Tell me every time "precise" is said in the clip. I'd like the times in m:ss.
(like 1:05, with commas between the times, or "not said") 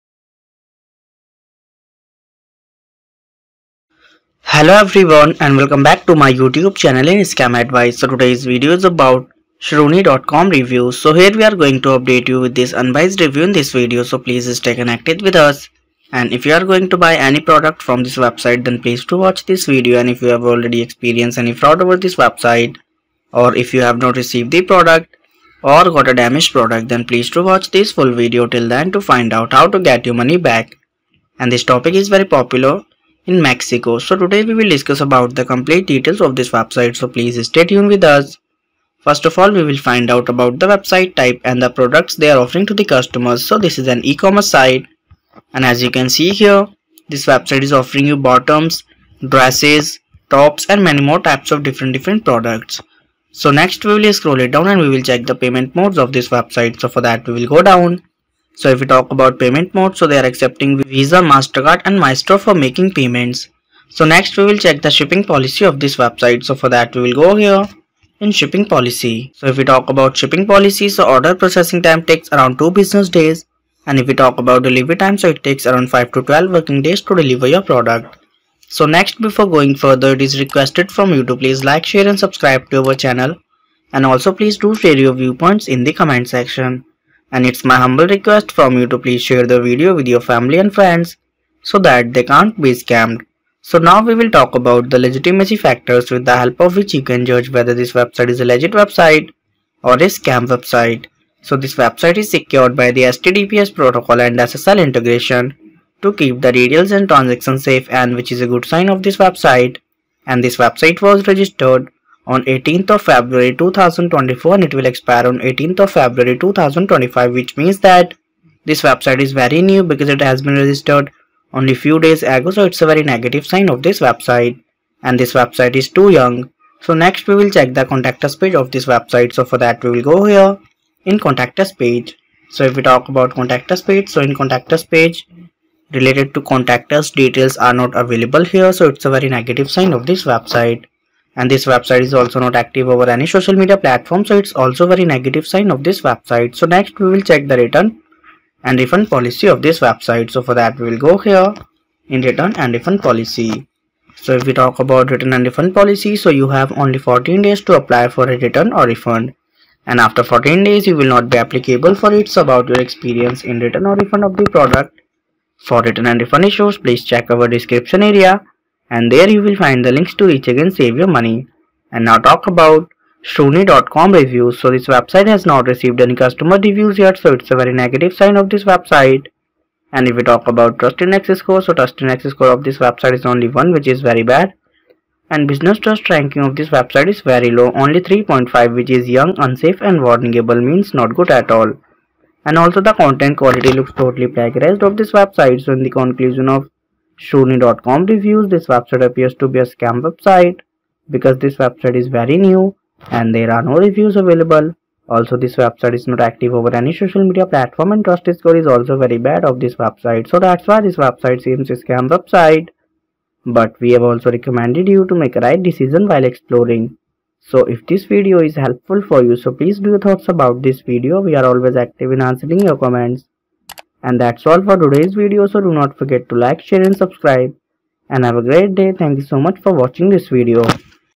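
not said.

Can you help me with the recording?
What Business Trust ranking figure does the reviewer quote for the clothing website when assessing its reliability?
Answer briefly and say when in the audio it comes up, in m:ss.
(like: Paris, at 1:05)
3.5, at 3:08.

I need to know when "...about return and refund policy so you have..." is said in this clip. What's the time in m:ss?
2:34.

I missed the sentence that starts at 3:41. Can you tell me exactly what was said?
We are always active in answering your comments.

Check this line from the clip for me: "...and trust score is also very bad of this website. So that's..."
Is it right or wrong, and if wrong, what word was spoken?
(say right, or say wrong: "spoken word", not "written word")
right.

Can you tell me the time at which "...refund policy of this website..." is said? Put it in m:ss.
2:28.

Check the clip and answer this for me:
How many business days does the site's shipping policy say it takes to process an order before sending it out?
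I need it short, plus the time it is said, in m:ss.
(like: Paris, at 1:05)
2 business days, at 1:12.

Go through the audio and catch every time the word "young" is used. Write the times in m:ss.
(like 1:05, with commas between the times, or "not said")
2:06, 3:09.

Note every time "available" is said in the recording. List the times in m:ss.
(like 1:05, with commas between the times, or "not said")
2:17, 3:24.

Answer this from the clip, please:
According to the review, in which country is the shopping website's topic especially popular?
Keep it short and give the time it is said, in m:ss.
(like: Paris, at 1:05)
Mexico, at 0:33.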